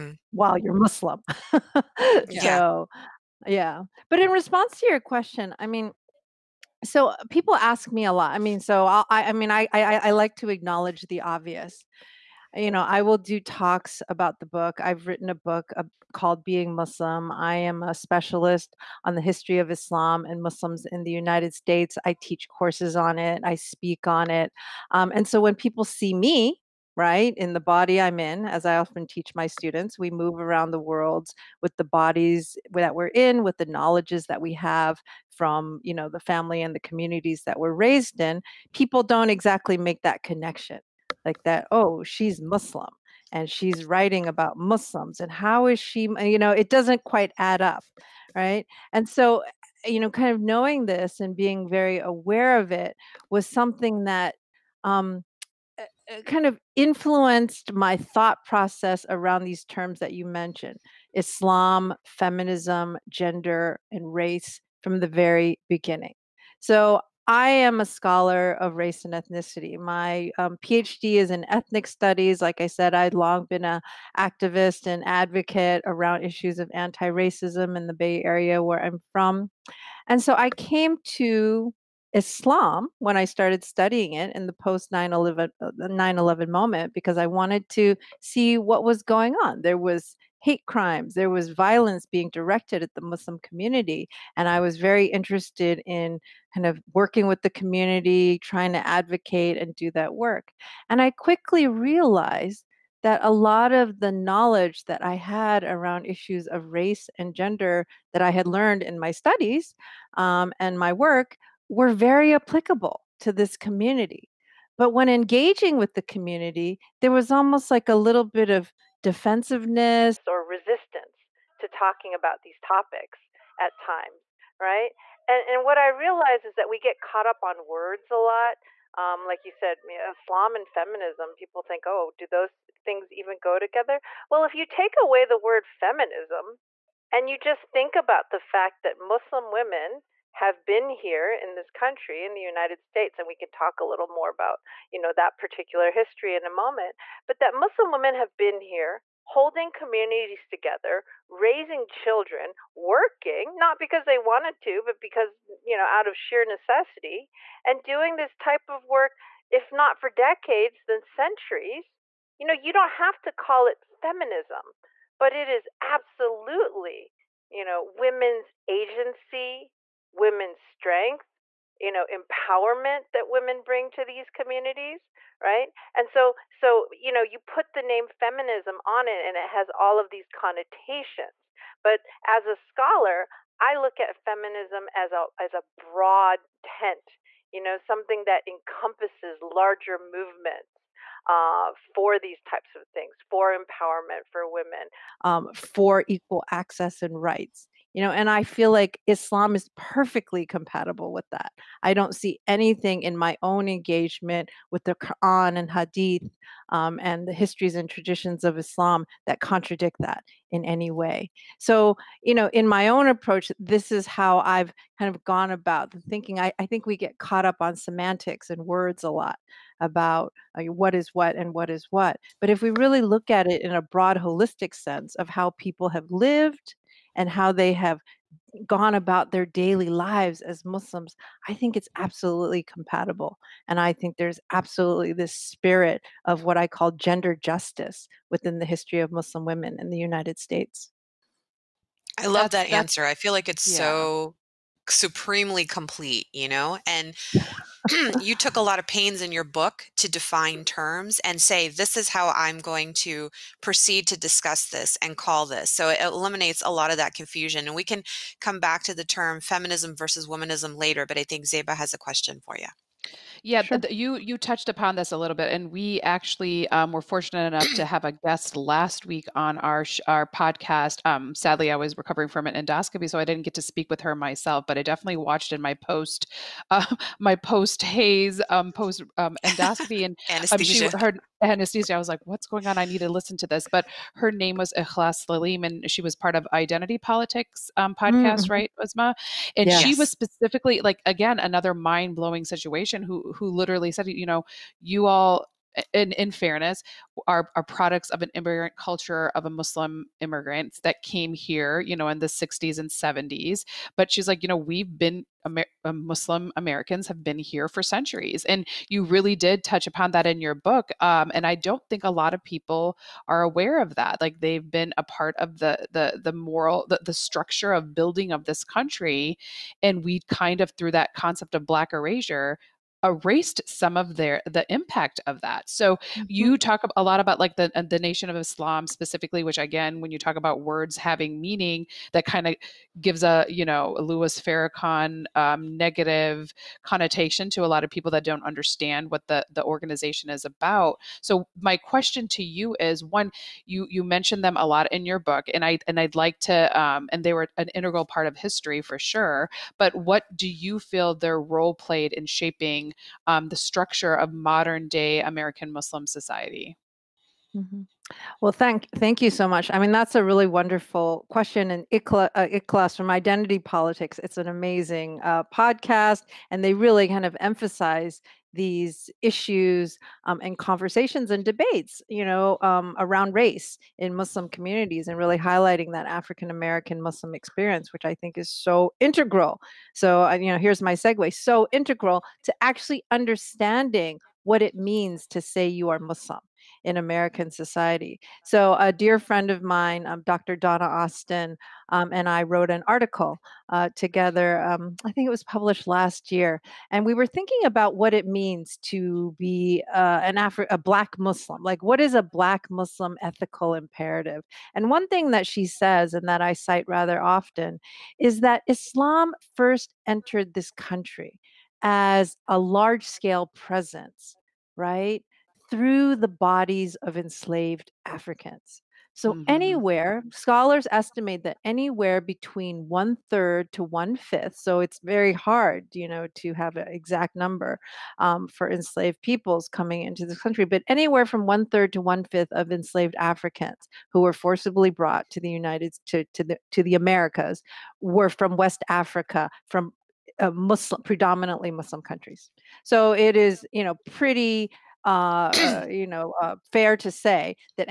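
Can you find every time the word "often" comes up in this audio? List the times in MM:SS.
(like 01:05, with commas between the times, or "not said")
00:28, 06:47.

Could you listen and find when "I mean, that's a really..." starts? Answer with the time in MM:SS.
05:59.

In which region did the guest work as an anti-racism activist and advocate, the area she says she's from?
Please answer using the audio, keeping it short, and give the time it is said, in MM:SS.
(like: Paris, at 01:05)
The Bay Area, at 01:17.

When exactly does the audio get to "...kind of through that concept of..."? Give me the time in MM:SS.
05:20.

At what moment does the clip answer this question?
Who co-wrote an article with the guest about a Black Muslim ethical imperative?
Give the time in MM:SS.
06:30.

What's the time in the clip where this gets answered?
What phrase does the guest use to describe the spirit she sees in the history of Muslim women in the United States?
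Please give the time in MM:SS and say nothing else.
03:56.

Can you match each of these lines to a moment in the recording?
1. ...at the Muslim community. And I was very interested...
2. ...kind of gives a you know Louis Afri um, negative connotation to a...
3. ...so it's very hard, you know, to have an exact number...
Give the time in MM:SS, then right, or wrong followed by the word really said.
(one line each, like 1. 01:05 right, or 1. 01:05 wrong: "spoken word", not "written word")
1. 01:32 right
2. 05:32 wrong: "Farrakhan", not "Afri"
3. 07:04 right.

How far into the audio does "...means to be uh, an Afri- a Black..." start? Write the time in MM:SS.
06:38.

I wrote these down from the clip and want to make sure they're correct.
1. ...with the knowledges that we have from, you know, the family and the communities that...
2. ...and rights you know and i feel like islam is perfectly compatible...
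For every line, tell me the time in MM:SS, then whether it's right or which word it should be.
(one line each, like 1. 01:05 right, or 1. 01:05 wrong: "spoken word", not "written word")
1. 00:33 right
2. 03:17 right.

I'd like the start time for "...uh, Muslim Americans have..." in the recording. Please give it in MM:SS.
05:05.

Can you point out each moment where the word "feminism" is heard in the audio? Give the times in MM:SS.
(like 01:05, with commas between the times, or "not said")
01:02, 02:10, 02:15, 02:44, 02:58, 03:04, 04:19.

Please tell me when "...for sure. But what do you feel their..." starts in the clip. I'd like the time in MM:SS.
05:48.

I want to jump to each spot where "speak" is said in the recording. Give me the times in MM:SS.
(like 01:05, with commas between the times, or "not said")
00:23, 04:33.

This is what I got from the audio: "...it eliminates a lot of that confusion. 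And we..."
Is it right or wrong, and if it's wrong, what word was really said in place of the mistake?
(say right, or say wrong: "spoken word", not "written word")
right.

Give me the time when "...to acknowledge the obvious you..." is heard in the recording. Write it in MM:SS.
00:10.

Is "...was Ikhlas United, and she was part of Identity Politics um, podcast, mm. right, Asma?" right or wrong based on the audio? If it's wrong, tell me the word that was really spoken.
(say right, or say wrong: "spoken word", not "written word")
wrong: "Saleem", not "United".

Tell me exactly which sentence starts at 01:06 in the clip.
So I am a scholar of race and ethnicity.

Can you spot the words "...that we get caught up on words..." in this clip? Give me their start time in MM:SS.
02:06.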